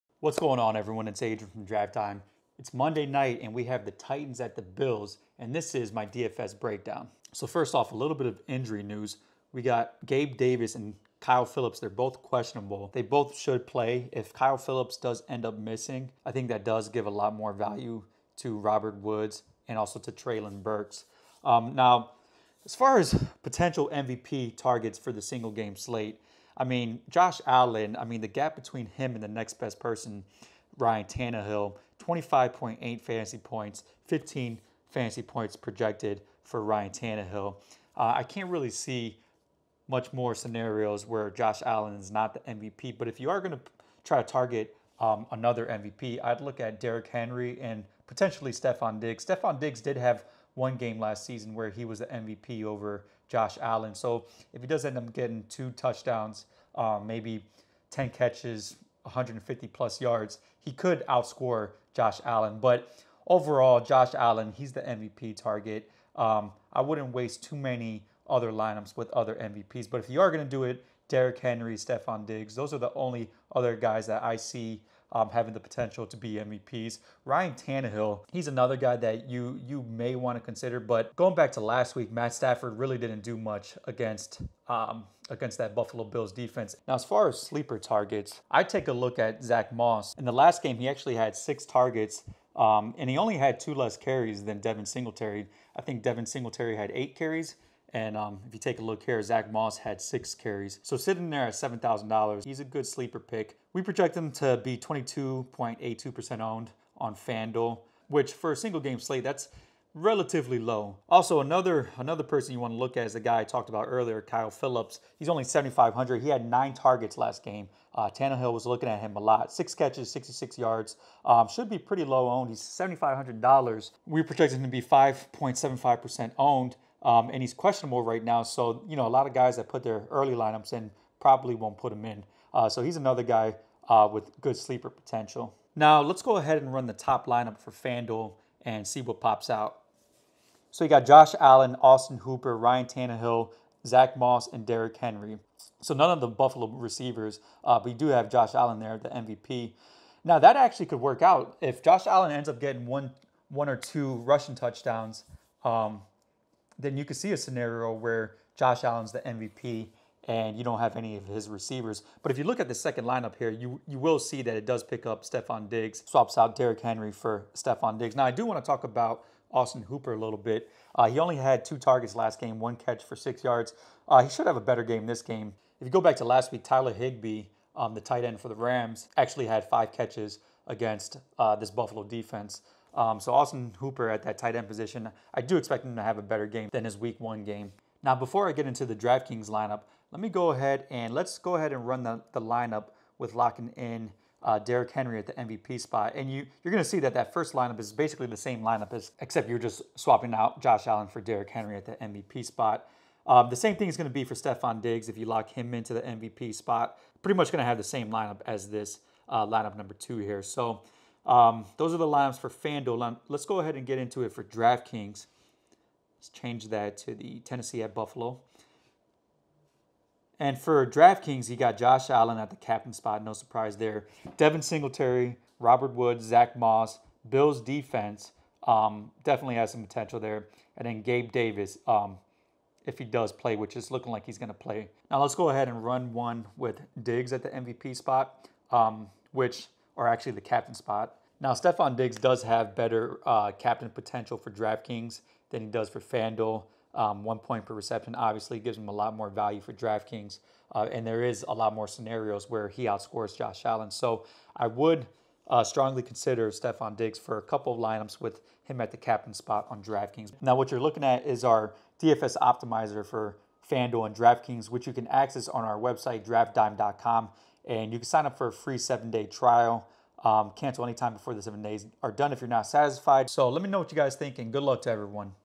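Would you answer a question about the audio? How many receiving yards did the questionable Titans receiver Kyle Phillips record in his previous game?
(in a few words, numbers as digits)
66.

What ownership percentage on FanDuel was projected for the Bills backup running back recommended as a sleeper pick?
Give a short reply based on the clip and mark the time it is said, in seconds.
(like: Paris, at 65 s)
22.82%, at 104 s.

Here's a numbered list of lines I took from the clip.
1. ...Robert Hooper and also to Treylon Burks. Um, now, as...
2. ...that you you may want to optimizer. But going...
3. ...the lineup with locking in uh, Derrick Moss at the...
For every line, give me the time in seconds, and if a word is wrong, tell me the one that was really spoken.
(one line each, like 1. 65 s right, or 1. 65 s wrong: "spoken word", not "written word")
1. 18 s wrong: "Woods", not "Hooper"
2. 78 s wrong: "consider", not "optimizer"
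3. 192 s wrong: "Henry", not "Moss".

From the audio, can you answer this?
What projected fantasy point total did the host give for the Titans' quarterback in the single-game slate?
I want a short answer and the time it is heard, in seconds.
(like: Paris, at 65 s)
15, at 34 s.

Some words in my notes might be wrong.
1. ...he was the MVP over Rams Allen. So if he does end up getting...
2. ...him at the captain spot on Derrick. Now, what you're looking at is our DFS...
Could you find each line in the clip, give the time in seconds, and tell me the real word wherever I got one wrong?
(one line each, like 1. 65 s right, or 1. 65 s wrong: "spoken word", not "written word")
1. 51 s wrong: "Josh", not "Rams"
2. 258 s wrong: "DraftKings", not "Derrick".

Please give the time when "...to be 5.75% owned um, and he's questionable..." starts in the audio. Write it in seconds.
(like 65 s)
124 s.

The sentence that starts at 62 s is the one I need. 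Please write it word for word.
But overall, Josh Allen, he's the MVP target.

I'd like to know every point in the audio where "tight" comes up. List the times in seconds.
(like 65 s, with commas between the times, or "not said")
178 s, 184 s.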